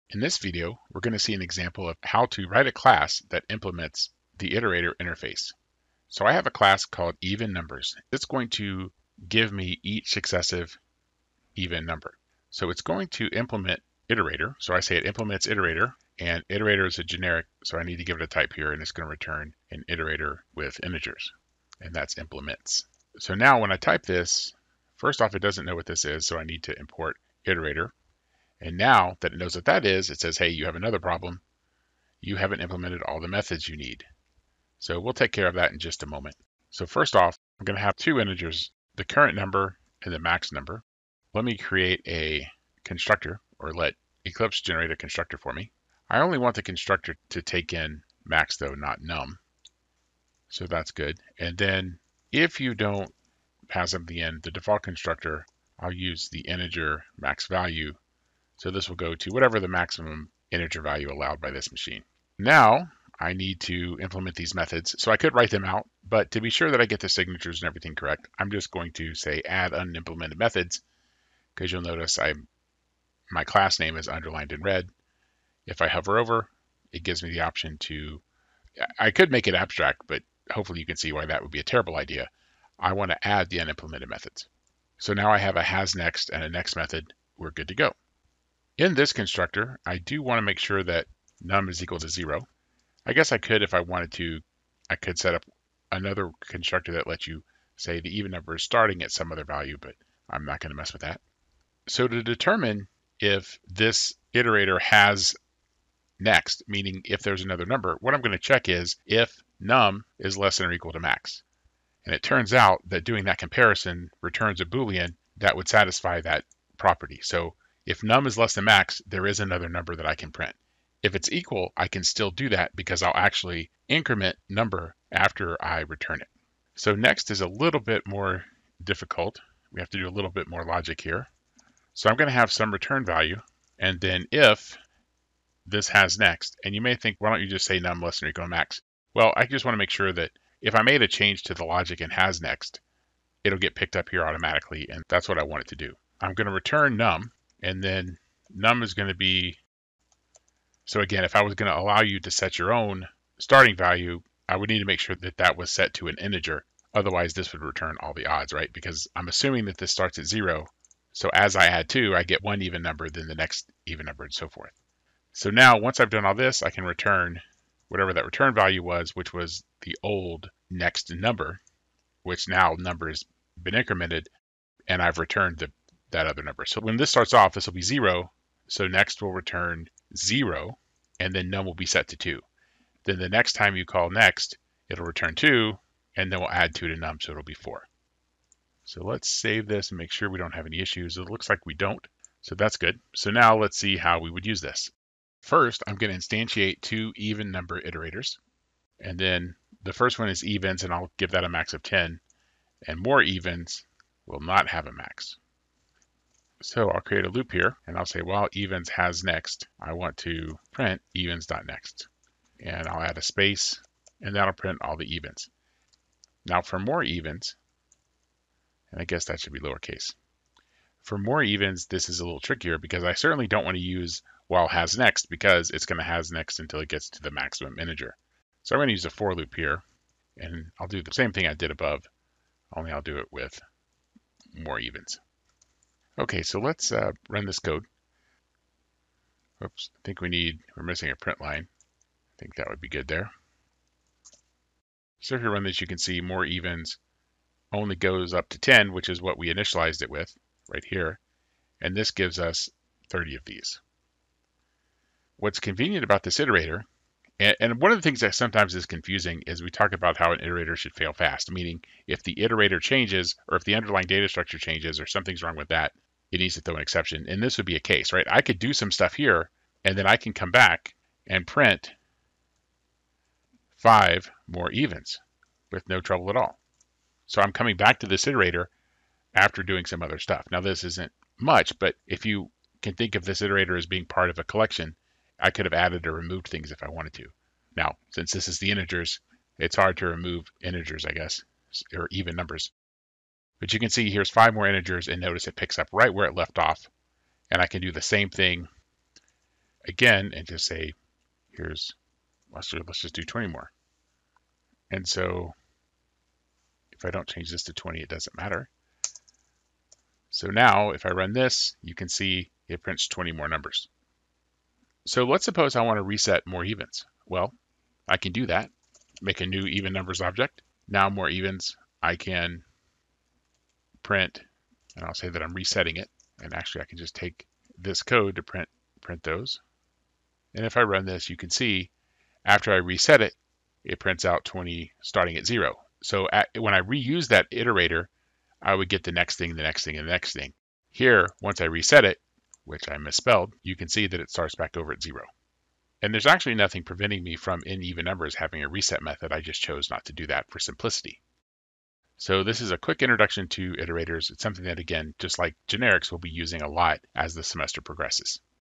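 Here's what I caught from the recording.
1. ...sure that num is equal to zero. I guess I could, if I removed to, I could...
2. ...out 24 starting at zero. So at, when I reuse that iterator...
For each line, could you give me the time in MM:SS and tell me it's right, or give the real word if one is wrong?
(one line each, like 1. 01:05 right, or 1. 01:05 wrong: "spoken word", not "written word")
1. 01:30 wrong: "wanted", not "removed"
2. 05:34 wrong: "20", not "24".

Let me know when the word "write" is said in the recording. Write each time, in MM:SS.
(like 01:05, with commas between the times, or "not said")
00:02, 01:05.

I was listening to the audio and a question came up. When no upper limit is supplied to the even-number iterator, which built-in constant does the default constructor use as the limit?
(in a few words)
integer max value.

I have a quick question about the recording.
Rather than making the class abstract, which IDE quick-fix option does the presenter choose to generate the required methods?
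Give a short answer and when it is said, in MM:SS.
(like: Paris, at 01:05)
add unimplemented methods, at 01:09.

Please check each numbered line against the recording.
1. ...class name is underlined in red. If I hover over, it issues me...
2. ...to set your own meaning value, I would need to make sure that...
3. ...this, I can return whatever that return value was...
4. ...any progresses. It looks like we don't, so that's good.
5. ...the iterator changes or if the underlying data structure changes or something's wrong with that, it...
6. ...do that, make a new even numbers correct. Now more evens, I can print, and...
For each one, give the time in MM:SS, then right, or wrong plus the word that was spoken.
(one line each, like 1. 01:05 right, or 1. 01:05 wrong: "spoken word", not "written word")
1. 01:13 wrong: "gives", not "issues"
2. 02:32 wrong: "starting", not "meaning"
3. 02:46 right
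4. 03:10 wrong: "issues", not "progresses"
5. 04:22 right
6. 05:18 wrong: "object", not "correct".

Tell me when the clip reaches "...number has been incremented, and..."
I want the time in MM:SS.
02:52.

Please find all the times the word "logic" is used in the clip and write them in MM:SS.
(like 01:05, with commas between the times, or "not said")
02:10, 02:21.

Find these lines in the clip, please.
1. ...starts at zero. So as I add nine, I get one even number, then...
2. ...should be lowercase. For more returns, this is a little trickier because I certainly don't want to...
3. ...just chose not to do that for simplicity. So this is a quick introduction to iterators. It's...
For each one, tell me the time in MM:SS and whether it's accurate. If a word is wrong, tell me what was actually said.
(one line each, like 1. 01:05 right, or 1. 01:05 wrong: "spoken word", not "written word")
1. 02:39 wrong: "two", not "nine"
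2. 03:39 wrong: "evens", not "returns"
3. 05:49 right.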